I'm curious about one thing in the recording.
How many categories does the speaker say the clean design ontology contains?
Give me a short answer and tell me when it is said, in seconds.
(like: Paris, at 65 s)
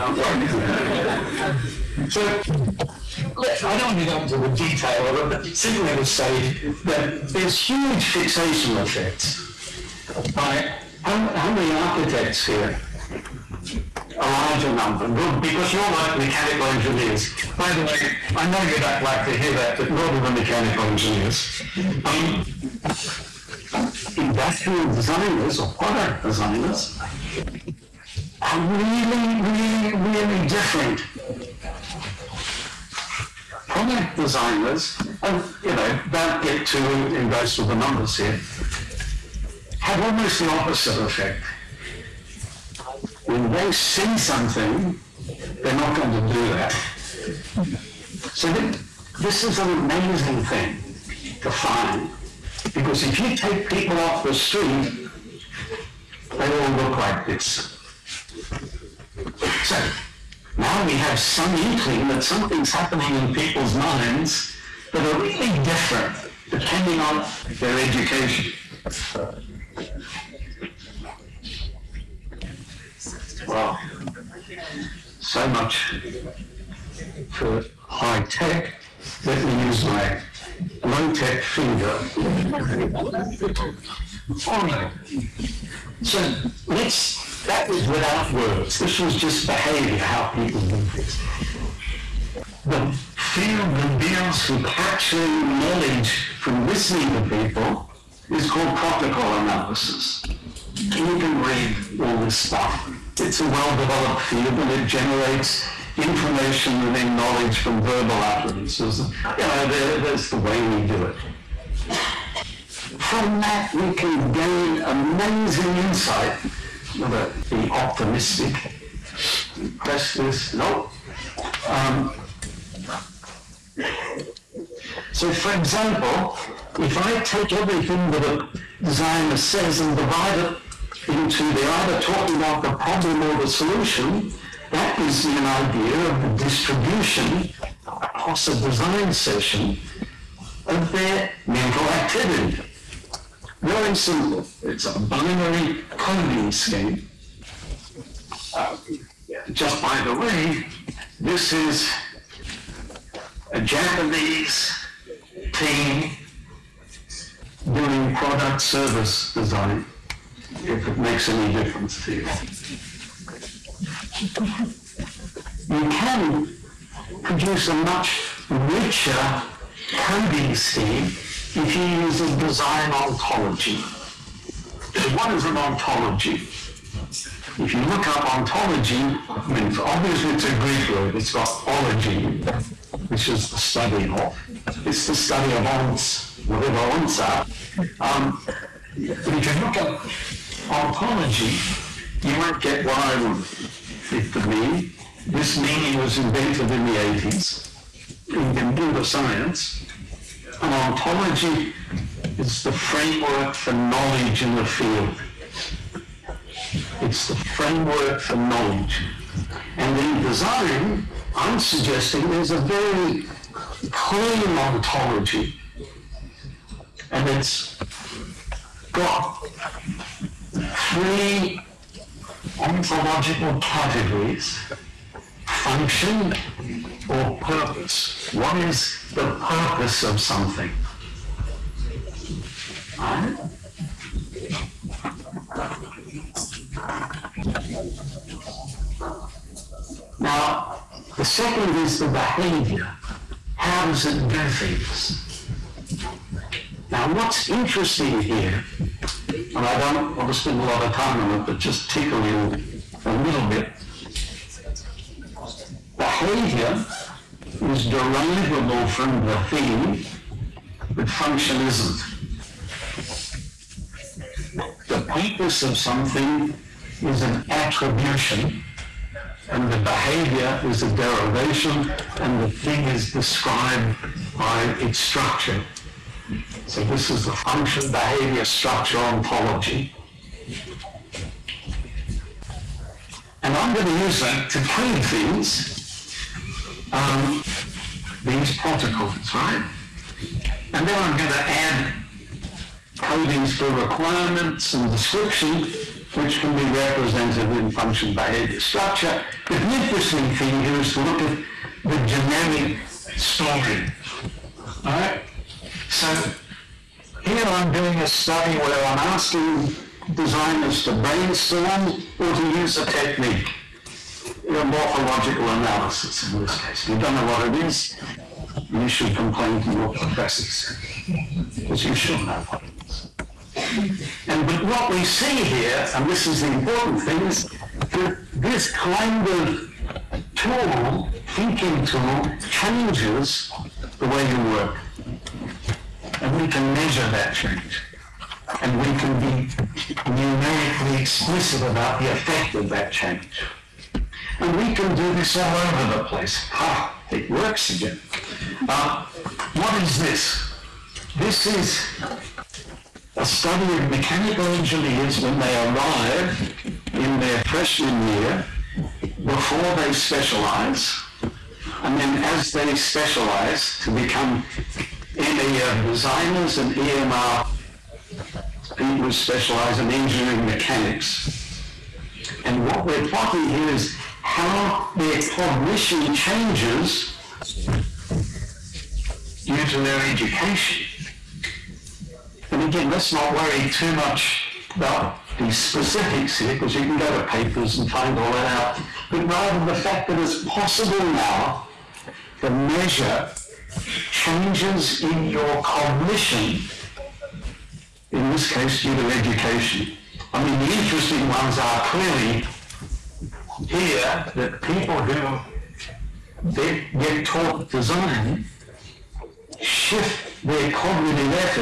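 3, at 220 s.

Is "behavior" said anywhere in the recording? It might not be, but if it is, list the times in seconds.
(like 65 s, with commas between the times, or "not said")
89 s, 242 s, 255 s, 269 s, 277 s, 298 s.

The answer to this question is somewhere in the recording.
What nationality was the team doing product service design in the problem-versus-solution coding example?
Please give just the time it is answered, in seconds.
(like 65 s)
153 s.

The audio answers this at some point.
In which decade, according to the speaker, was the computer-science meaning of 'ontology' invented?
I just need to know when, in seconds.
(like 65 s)
196 s.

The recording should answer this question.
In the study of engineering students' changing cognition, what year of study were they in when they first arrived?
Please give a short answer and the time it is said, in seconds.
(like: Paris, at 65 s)
Freshman year, at 357 s.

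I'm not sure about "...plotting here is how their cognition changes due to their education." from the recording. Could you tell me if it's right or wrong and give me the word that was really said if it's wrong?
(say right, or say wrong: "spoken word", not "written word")
right.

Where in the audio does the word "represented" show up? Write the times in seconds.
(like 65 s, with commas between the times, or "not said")
296 s.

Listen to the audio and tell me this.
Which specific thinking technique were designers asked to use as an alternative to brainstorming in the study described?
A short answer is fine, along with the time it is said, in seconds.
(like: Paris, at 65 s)
Morphological analysis, at 314 s.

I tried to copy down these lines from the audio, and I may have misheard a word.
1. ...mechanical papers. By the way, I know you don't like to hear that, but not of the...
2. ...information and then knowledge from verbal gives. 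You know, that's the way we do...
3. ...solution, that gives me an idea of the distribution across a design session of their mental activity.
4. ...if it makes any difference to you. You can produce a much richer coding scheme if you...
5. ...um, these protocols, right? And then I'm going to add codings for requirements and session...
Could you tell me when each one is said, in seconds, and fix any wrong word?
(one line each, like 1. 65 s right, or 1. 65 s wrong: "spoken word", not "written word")
1. 16 s wrong: "engineers", not "papers"
2. 105 s wrong: "utterances", not "gives"
3. 133 s right
4. 160 s right
5. 286 s wrong: "description", not "session".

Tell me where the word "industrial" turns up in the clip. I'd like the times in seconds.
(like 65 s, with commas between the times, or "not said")
24 s.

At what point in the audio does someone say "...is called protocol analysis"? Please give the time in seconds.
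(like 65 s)
98 s.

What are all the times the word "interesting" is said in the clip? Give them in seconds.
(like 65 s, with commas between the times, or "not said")
247 s, 299 s, 400 s.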